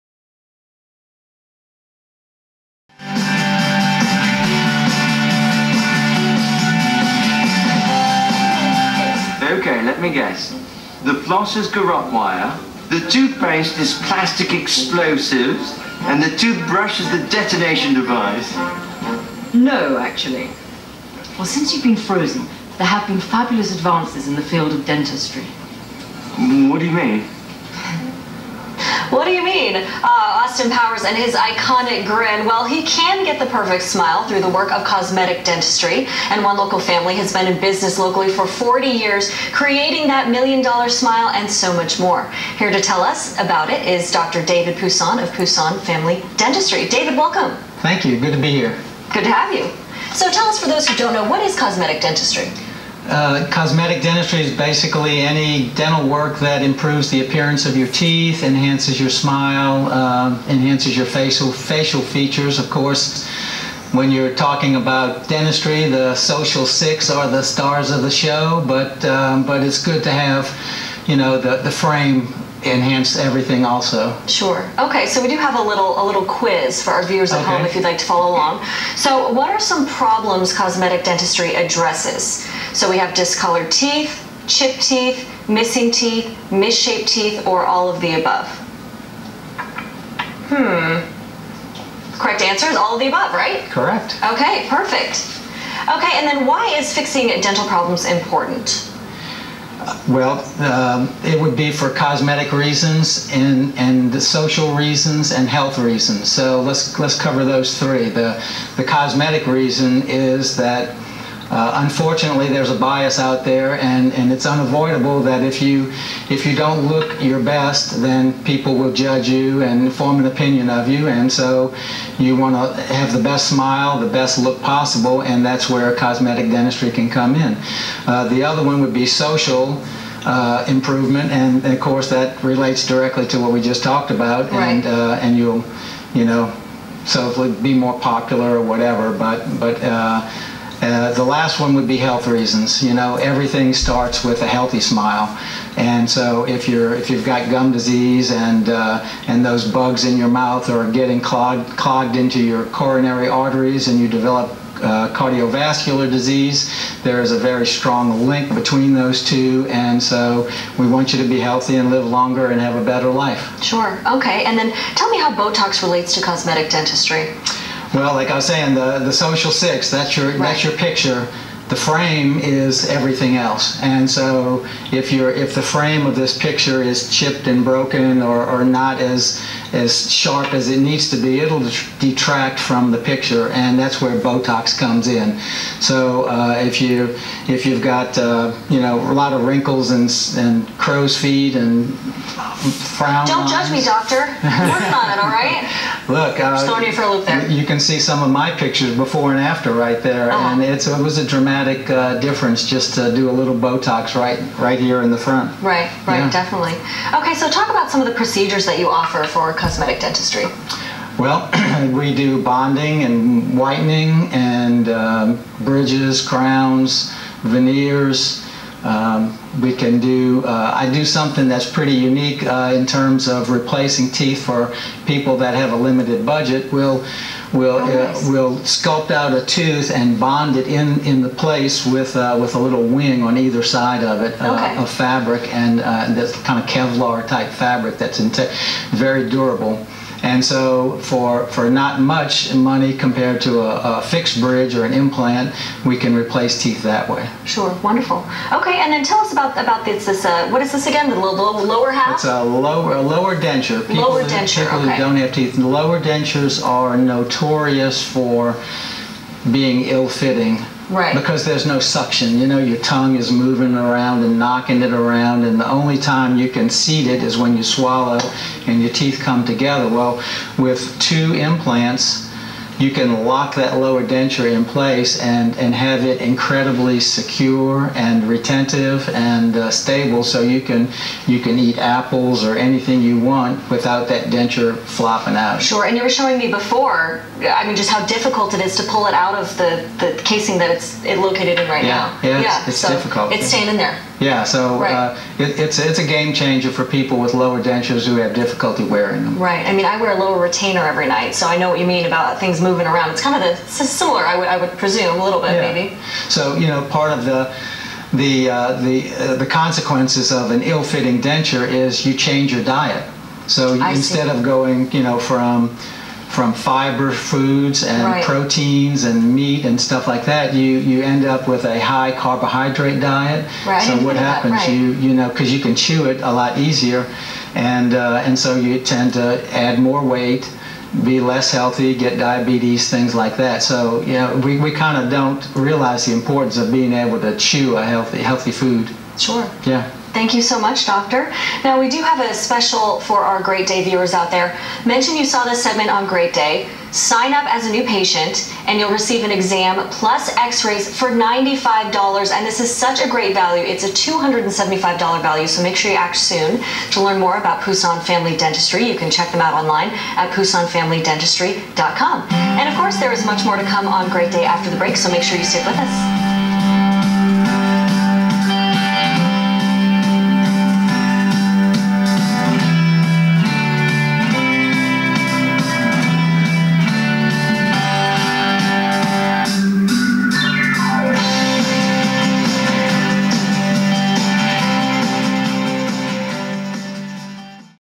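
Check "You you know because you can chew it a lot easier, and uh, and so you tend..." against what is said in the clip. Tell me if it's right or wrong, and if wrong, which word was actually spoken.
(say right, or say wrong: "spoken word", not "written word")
right.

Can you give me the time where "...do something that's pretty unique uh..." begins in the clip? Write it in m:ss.
3:40.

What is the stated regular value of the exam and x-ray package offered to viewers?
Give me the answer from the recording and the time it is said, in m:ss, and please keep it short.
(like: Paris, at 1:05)
$275, at 5:53.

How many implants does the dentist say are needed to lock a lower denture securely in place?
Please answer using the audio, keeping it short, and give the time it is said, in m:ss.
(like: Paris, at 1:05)
2, at 4:30.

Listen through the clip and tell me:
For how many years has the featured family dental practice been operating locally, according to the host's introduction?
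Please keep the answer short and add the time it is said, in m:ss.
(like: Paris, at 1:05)
40, at 0:38.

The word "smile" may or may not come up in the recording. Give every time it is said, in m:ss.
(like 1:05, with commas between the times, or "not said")
0:33, 0:40, 0:59, 2:03, 2:24.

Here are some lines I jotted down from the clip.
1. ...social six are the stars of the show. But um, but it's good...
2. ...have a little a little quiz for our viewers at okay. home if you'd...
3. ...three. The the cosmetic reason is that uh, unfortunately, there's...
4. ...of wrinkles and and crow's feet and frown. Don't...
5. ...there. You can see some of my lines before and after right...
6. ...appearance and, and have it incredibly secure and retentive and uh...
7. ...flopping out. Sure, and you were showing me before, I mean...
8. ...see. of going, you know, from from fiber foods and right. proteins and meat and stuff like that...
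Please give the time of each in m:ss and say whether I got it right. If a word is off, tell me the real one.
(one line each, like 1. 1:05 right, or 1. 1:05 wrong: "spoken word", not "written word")
1. 1:06 right
2. 1:15 right
3. 1:47 right
4. 3:09 right
5. 3:17 wrong: "pictures", not "lines"
6. 4:34 wrong: "place", not "appearance"
7. 4:44 right
8. 5:14 right.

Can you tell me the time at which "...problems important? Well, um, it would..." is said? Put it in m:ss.
1:37.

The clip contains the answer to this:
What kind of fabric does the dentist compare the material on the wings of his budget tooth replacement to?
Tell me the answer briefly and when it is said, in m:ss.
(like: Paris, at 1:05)
Kevlar, at 3:56.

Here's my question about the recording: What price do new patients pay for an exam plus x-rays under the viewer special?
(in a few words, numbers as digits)
$95.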